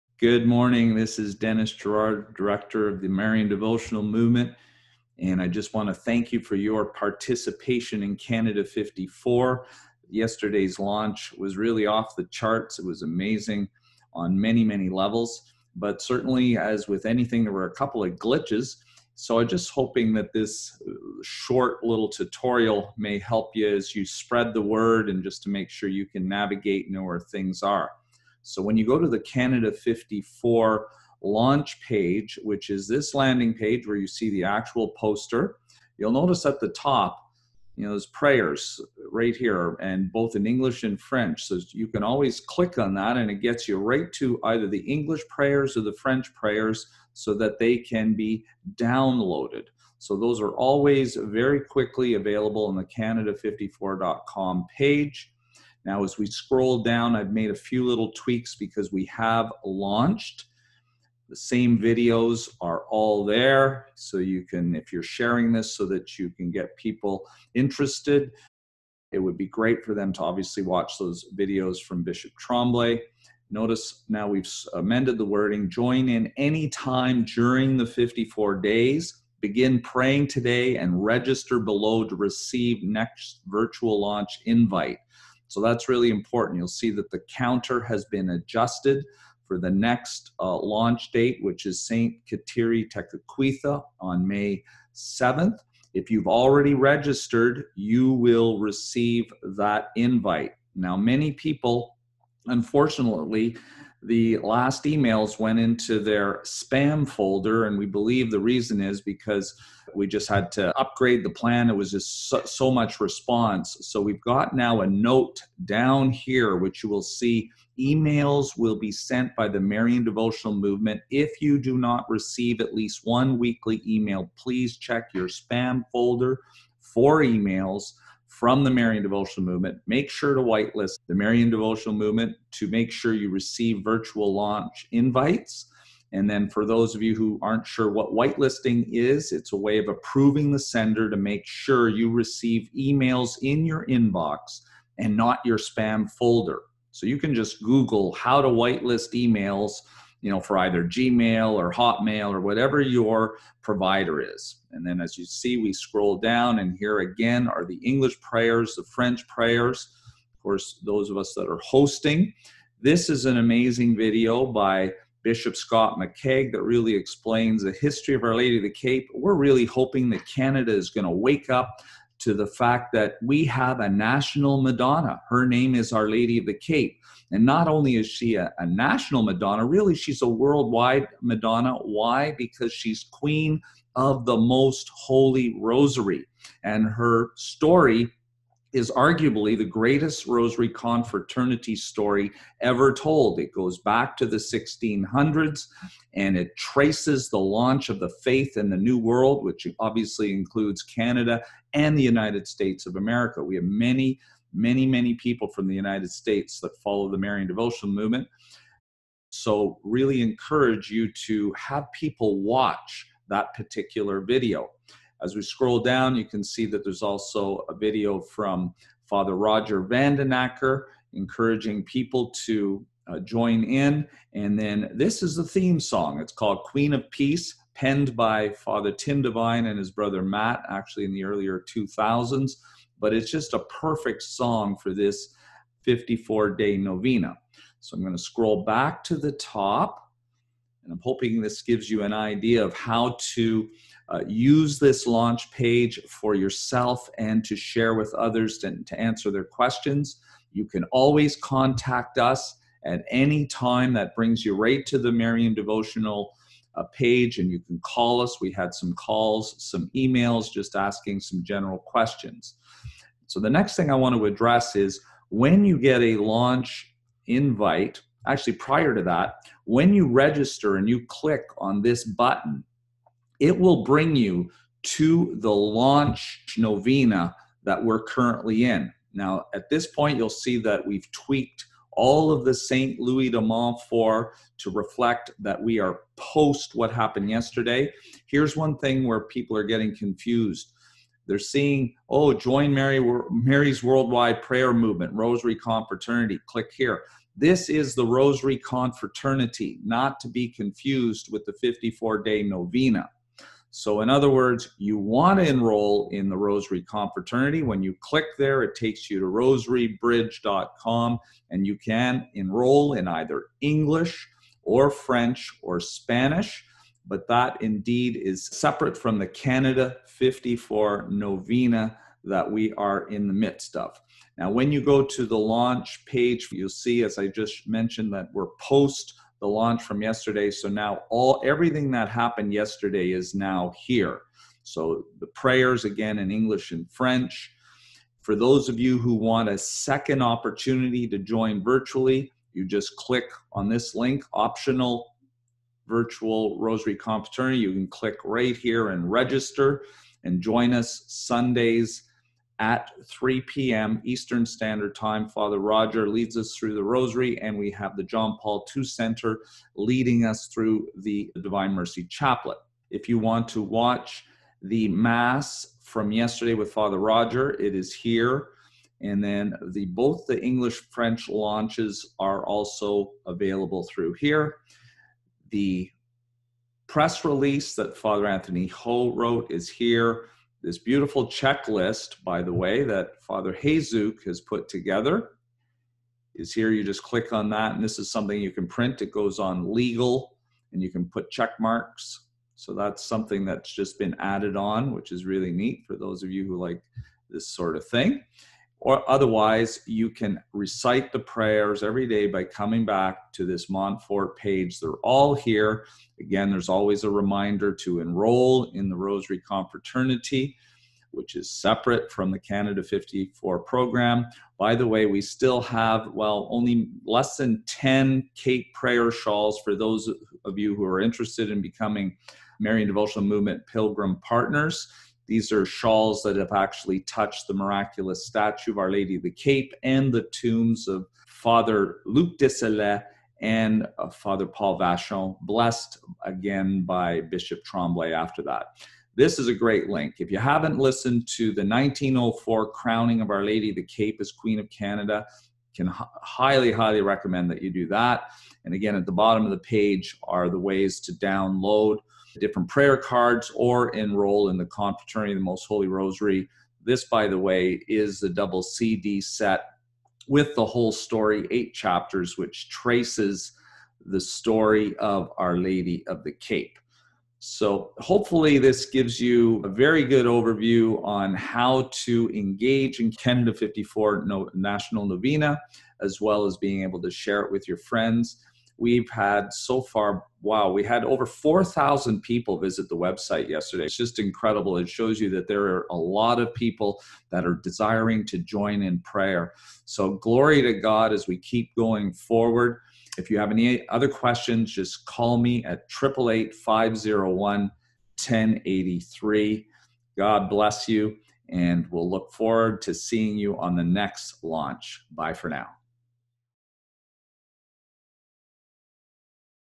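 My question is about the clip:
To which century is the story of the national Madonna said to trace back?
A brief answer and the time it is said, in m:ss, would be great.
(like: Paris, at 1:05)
1600s, at 3:14.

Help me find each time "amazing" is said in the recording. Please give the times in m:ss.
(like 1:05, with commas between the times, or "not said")
0:13, 2:43.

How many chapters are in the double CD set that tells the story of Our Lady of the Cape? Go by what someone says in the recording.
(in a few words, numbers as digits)
8.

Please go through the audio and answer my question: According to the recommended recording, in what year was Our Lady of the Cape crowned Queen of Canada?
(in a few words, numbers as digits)
1904.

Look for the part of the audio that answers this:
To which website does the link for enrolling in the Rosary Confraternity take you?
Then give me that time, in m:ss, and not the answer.
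5:09.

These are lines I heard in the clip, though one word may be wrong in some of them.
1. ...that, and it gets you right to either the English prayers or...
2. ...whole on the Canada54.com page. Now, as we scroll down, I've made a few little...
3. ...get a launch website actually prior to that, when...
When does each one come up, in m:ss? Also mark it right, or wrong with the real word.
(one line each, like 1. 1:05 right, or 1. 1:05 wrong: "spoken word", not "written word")
1. 0:42 right
2. 0:52 wrong: "available", not "whole"
3. 4:25 wrong: "invite", not "website".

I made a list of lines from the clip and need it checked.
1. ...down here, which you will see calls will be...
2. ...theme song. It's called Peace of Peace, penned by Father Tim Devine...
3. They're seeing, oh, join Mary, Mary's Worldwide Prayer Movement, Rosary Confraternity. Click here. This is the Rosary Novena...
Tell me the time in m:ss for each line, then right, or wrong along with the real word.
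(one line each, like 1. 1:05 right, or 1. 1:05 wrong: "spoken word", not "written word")
1. 1:55 wrong: "emails", not "calls"
2. 3:45 wrong: "Queen", not "Peace"
3. 4:51 wrong: "Confraternity", not "Novena".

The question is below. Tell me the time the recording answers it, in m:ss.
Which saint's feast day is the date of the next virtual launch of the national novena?
1:31.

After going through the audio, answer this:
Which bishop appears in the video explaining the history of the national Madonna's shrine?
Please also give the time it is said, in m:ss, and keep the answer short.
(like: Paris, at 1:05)
Bishop Scott McCaig, at 2:45.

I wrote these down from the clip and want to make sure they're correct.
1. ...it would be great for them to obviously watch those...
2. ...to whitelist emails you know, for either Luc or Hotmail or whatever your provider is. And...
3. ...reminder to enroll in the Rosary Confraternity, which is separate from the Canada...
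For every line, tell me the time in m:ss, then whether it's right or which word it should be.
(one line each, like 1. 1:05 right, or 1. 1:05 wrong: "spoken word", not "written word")
1. 1:09 right
2. 2:28 wrong: "Gmail", not "Luc"
3. 6:47 right.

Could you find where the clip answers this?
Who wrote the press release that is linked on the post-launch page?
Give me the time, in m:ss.
6:17.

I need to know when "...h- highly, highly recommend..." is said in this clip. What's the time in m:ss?
7:25.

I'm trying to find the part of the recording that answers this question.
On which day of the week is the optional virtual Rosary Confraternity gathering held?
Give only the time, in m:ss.
5:51.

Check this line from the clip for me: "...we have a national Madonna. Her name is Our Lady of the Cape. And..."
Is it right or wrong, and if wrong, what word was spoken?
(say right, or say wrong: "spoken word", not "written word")
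right.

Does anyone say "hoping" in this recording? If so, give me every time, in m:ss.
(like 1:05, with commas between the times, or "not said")
0:19, 2:49, 4:01.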